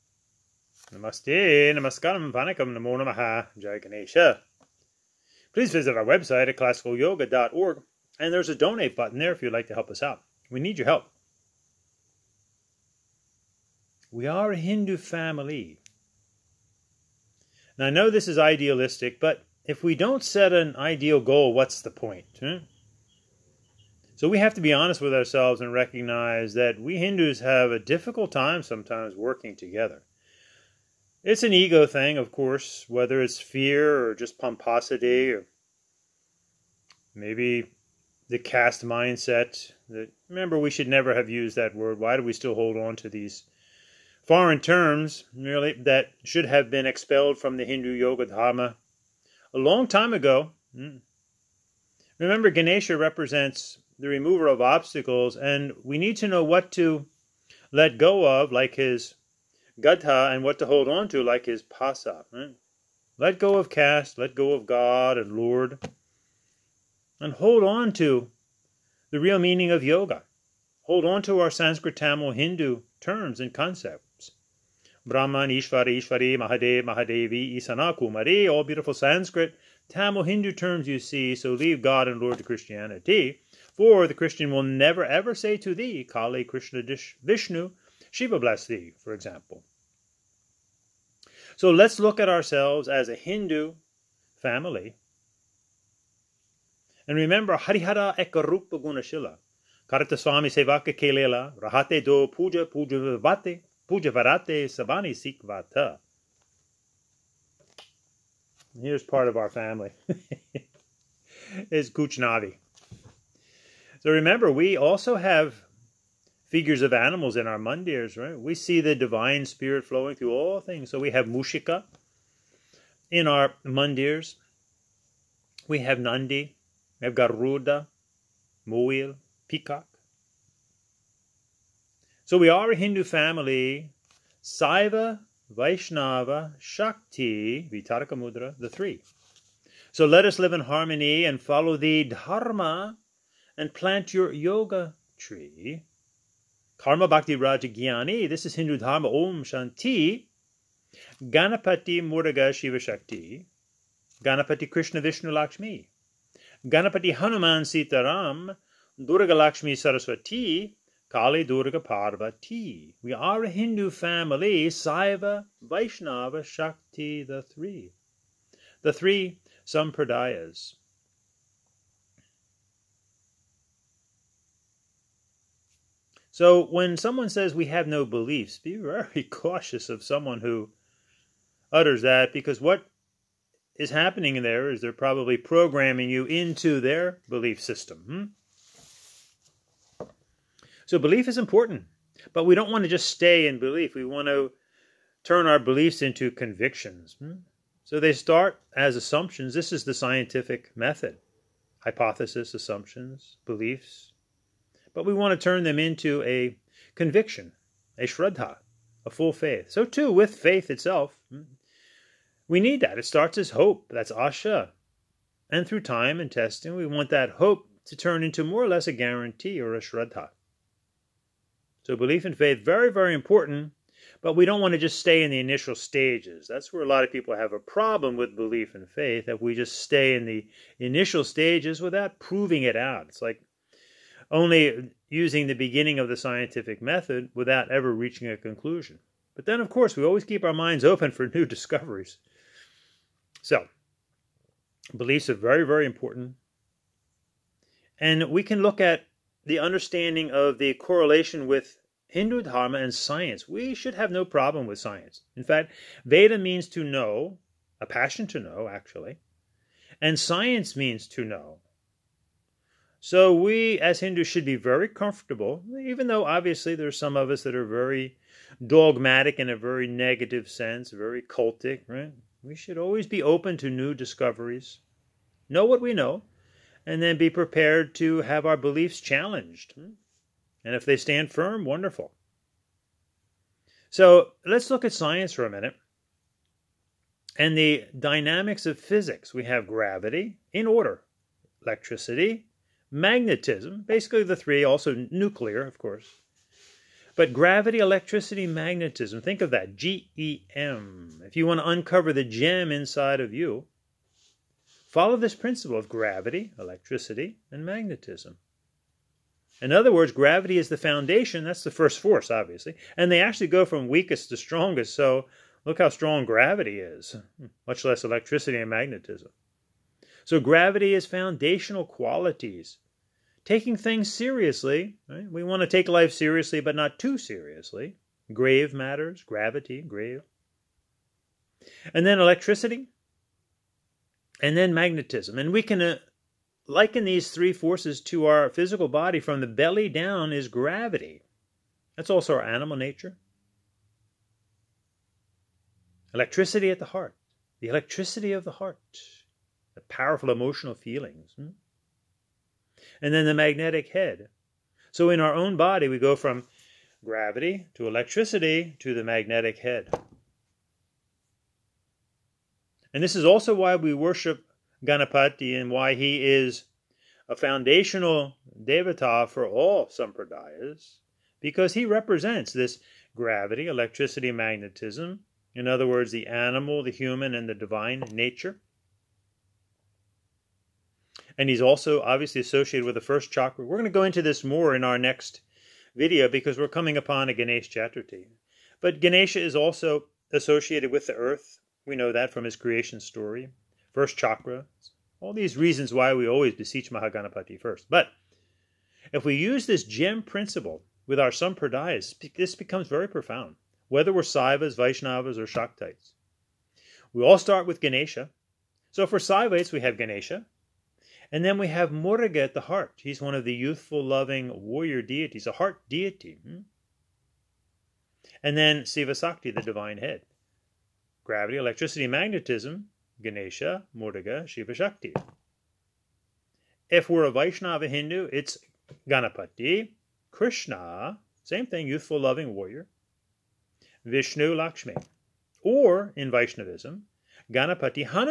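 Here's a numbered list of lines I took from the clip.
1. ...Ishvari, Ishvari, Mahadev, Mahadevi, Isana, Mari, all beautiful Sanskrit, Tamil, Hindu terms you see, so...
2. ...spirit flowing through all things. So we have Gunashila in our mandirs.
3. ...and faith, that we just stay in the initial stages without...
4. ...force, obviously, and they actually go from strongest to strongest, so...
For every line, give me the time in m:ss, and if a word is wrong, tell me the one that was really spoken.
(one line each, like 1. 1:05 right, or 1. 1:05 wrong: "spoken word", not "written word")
1. 1:15 right
2. 1:59 wrong: "Mushika", not "Gunashila"
3. 3:48 right
4. 5:11 wrong: "weakest", not "strongest".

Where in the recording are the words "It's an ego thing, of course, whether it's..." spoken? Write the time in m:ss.
0:31.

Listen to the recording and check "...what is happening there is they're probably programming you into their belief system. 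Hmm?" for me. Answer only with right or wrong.
right.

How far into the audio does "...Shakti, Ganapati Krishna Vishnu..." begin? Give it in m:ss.
2:32.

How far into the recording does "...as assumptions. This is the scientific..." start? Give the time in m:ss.
3:18.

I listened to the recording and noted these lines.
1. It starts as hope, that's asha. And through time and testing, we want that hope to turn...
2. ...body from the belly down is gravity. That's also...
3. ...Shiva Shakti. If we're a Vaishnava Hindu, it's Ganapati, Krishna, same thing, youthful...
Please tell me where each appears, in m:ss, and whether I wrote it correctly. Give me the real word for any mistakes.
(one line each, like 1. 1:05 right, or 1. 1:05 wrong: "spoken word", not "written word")
1. 3:32 right
2. 5:38 right
3. 7:04 right.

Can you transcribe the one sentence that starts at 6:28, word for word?
But Ganesha is also associated with the earth.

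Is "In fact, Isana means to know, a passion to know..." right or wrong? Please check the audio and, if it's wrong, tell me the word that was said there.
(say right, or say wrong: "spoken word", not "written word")
wrong: "Veda", not "Isana".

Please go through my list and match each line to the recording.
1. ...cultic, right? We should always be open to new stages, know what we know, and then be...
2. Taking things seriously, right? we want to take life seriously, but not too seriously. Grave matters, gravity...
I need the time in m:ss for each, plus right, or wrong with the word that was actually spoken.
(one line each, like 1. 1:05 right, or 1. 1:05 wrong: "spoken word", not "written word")
1. 4:31 wrong: "discoveries", not "stages"
2. 5:23 right.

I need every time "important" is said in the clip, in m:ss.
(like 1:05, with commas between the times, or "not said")
3:11, 3:43, 4:05.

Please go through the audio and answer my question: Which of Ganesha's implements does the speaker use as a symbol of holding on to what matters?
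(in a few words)
pasa.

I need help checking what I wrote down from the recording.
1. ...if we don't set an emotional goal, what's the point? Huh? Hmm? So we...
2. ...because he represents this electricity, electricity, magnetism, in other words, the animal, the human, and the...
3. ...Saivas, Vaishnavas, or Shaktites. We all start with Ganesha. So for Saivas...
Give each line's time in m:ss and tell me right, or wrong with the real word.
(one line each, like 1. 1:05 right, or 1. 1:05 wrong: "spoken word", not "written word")
1. 0:19 wrong: "ideal", not "emotional"
2. 6:11 wrong: "gravity", not "electricity"
3. 6:44 right.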